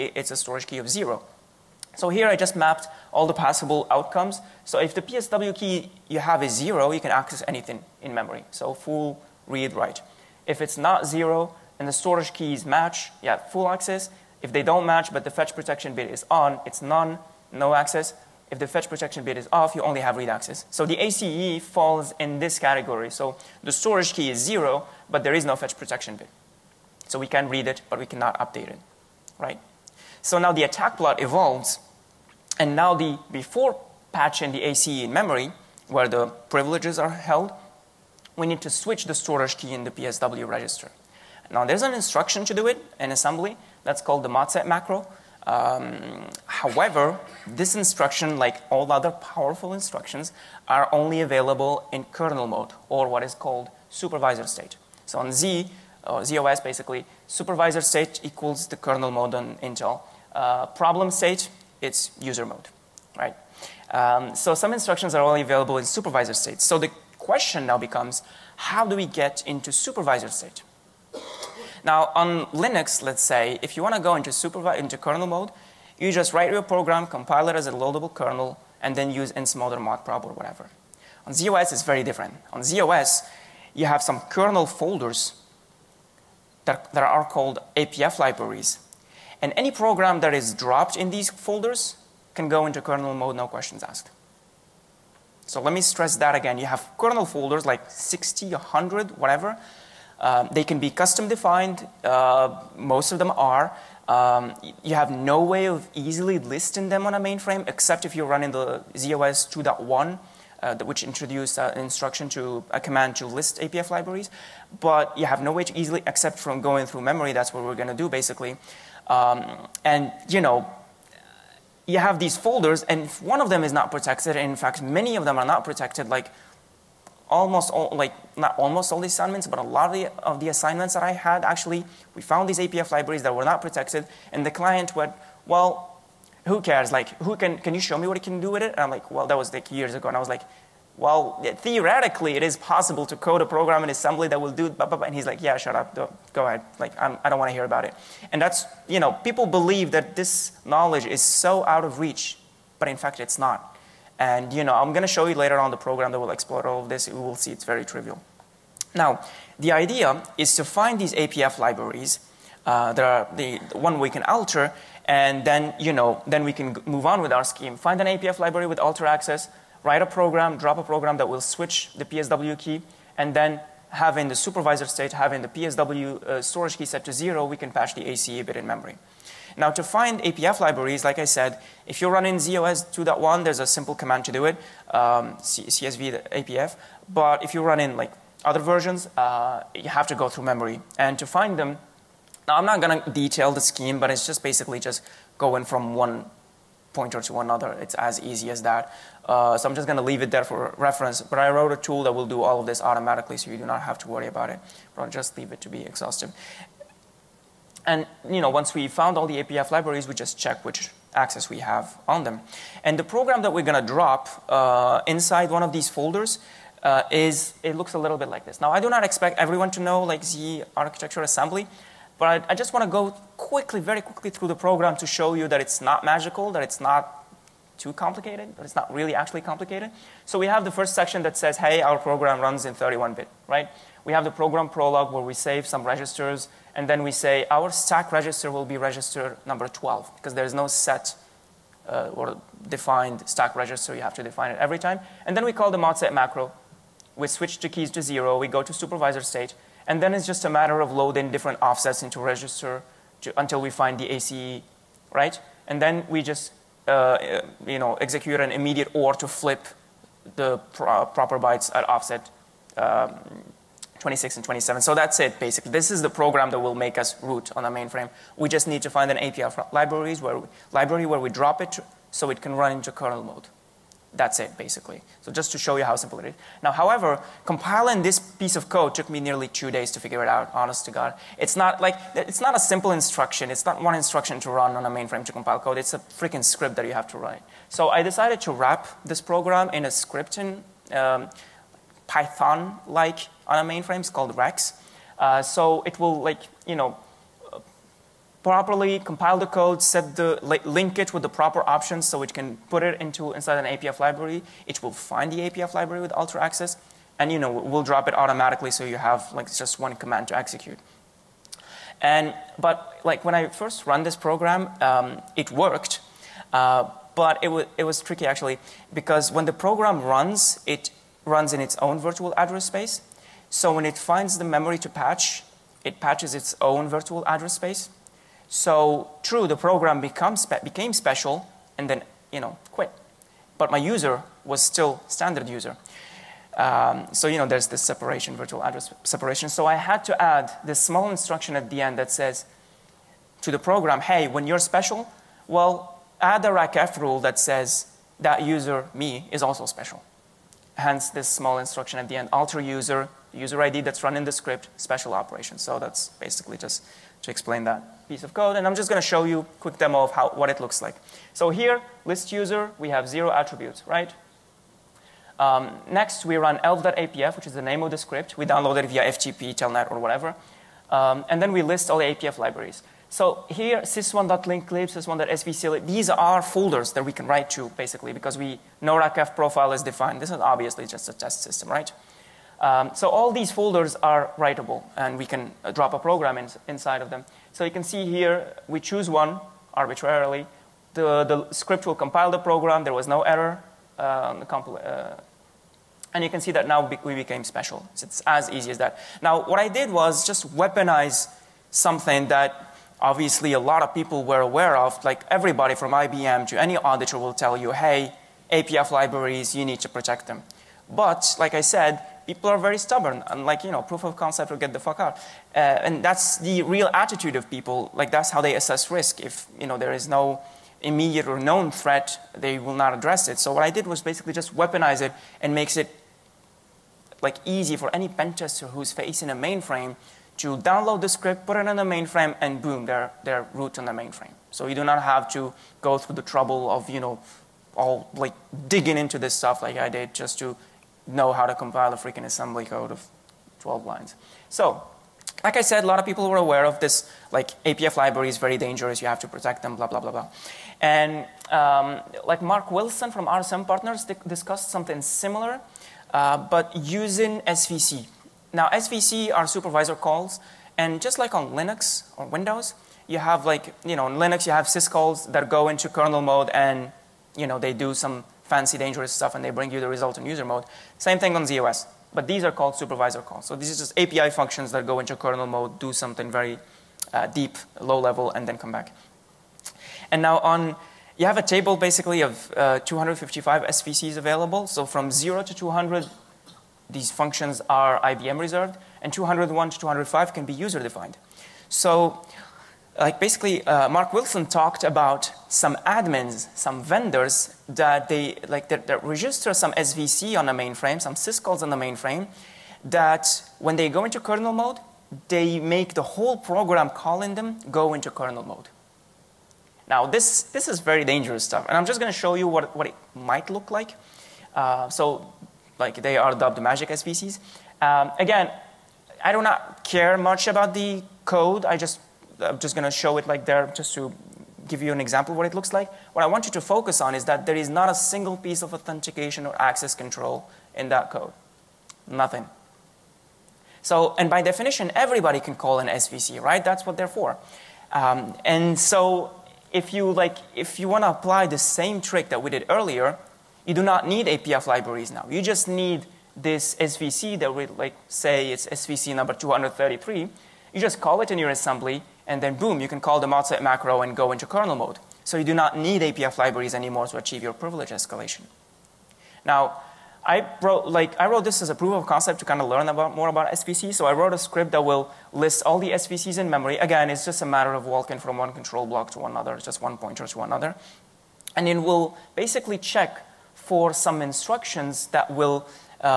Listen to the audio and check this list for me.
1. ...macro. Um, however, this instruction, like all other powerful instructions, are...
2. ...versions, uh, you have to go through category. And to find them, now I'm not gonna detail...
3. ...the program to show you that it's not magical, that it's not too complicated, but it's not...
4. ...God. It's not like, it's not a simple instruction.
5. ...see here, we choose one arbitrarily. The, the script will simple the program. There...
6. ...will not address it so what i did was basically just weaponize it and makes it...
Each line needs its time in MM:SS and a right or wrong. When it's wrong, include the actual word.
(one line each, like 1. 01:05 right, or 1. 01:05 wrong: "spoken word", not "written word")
1. 00:44 right
2. 03:08 wrong: "memory", not "category"
3. 03:44 right
4. 04:40 right
5. 06:27 wrong: "compile", not "simple"
6. 07:02 right.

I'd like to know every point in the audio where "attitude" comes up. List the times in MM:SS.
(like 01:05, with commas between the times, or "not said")
06:56.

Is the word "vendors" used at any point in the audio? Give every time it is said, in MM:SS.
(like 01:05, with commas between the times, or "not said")
08:16.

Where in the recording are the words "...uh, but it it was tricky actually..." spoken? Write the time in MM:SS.
05:16.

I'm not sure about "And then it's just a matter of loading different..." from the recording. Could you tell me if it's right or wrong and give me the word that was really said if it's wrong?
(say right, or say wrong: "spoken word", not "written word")
right.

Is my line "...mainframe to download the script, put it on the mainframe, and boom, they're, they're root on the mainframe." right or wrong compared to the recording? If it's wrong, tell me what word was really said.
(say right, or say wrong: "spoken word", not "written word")
right.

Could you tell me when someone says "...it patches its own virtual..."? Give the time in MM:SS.
05:25.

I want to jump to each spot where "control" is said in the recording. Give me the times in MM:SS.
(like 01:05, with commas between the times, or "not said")
08:49, 09:28.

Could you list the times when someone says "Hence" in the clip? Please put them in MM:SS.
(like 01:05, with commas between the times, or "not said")
05:50.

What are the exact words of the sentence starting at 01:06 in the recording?
So the question now becomes, how do we get into supervisor state?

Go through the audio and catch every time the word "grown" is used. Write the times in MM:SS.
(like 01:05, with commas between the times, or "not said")
not said.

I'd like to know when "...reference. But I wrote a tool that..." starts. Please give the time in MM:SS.
03:20.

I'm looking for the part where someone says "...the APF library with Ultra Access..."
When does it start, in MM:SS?
05:05.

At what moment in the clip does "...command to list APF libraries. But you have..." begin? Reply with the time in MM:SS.
01:52.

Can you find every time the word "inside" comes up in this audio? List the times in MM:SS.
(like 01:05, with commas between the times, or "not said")
03:35, 05:03, 06:26.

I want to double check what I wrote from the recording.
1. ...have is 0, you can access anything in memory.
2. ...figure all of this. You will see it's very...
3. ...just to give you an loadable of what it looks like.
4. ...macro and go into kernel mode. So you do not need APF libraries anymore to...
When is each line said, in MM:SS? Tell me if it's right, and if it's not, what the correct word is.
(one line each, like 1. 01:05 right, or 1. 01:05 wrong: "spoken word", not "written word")
1. 00:06 right
2. 02:36 wrong: "explore", not "figure"
3. 08:43 wrong: "example", not "loadable"
4. 09:13 right.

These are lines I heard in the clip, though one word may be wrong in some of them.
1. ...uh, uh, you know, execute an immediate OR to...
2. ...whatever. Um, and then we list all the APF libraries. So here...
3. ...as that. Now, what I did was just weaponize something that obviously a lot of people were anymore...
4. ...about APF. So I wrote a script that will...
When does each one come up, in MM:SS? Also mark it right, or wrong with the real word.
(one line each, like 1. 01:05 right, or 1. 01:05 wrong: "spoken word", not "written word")
1. 04:16 right
2. 06:09 right
3. 06:38 wrong: "aware", not "anymore"
4. 09:23 wrong: "SVC", not "APF".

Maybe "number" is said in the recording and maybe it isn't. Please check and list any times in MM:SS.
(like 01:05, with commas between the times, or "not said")
03:59, 09:09.